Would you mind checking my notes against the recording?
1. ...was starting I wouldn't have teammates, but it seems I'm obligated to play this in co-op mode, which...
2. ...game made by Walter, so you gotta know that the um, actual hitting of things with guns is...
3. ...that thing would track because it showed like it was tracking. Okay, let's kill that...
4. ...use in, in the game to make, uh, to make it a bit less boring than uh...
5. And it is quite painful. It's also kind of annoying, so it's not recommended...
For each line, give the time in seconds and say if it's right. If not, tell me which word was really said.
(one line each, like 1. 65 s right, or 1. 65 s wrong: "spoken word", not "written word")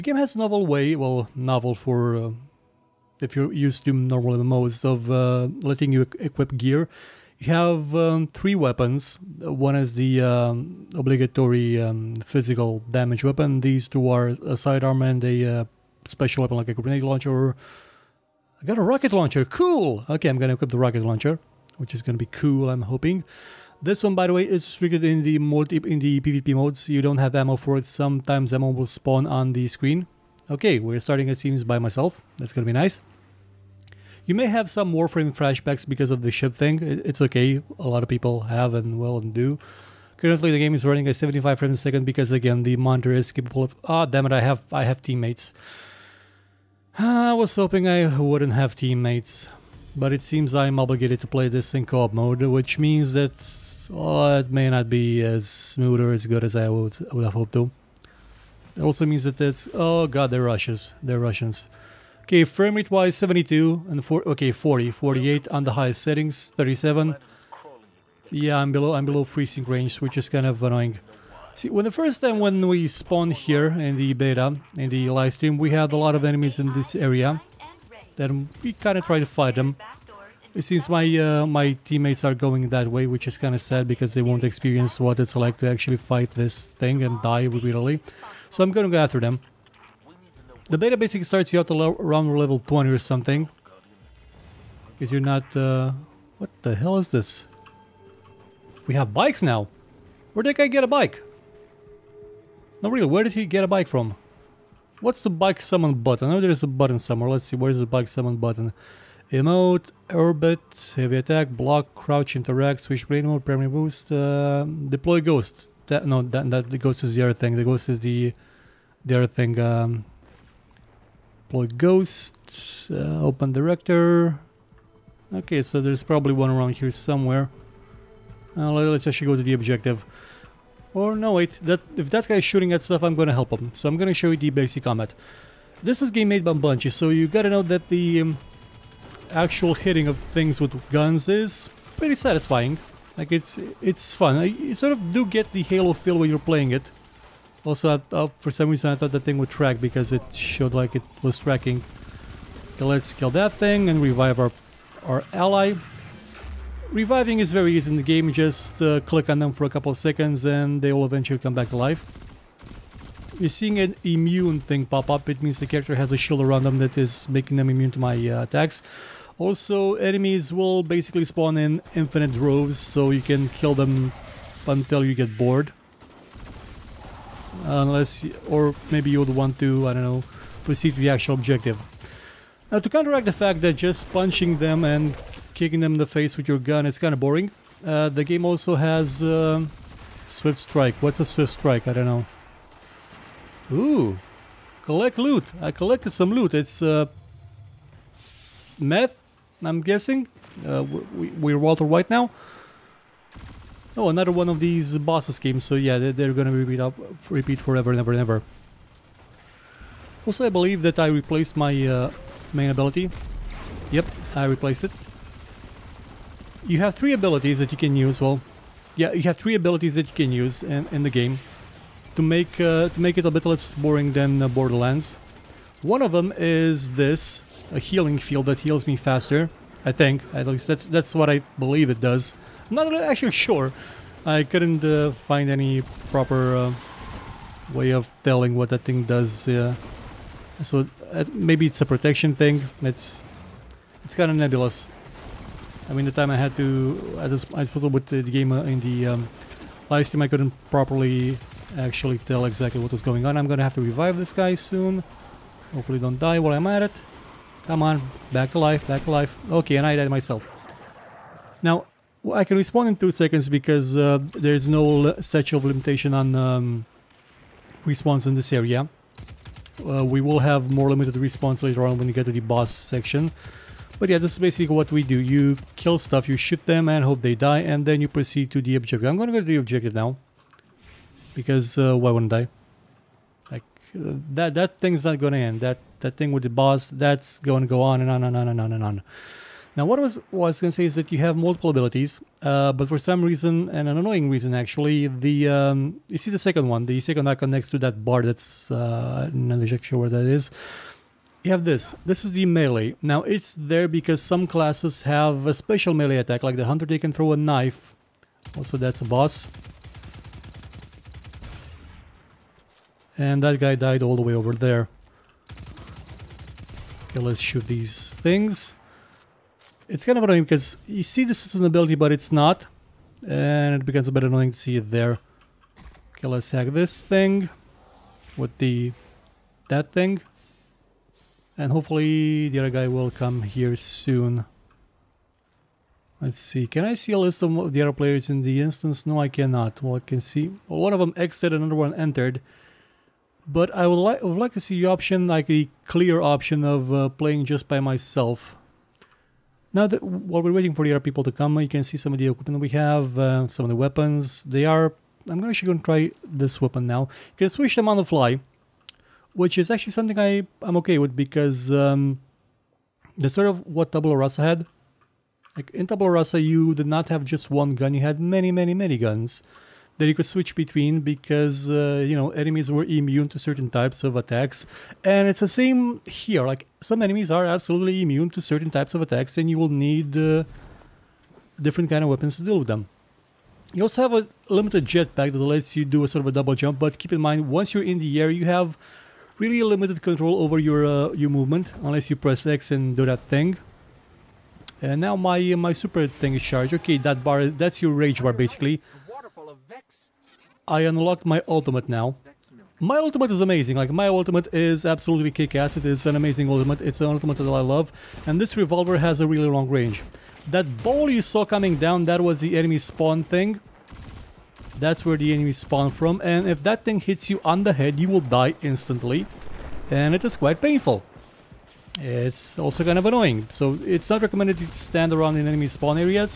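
1. 47 s wrong: "hoping", not "starting"
2. 136 s wrong: "Bungie", not "Walter"
3. 149 s right
4. 220 s right
5. 419 s right.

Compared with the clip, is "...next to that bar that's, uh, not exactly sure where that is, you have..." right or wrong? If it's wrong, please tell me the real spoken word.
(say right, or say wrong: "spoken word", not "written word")
right.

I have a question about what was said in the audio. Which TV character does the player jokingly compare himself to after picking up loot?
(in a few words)
Walter White.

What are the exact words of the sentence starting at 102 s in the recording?
No, really, where did he get a bike from?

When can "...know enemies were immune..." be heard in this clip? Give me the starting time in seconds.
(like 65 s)
372 s.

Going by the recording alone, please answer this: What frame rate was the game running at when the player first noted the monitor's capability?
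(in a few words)
75.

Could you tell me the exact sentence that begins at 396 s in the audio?
Okay, that bar that's your rage bar basically.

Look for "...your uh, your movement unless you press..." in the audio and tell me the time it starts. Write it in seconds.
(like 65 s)
390 s.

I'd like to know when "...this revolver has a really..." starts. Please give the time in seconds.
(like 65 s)
408 s.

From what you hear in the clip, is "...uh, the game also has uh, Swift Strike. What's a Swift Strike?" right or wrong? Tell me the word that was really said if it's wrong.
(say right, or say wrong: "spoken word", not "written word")
right.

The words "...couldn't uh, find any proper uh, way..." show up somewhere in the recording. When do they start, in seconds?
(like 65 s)
234 s.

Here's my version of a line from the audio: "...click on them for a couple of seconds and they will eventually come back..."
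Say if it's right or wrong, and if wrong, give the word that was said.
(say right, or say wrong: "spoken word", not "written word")
right.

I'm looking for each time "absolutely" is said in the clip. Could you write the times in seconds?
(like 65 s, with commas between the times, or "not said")
377 s, 404 s.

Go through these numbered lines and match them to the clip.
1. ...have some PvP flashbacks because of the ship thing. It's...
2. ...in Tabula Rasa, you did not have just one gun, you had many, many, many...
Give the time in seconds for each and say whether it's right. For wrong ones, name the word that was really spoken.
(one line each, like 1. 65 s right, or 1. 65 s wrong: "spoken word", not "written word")
1. 34 s wrong: "Warframe", not "PvP"
2. 365 s right.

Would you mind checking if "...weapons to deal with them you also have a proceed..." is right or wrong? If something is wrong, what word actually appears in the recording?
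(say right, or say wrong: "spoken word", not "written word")
wrong: "limited", not "proceed".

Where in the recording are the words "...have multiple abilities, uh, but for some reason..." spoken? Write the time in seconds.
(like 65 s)
291 s.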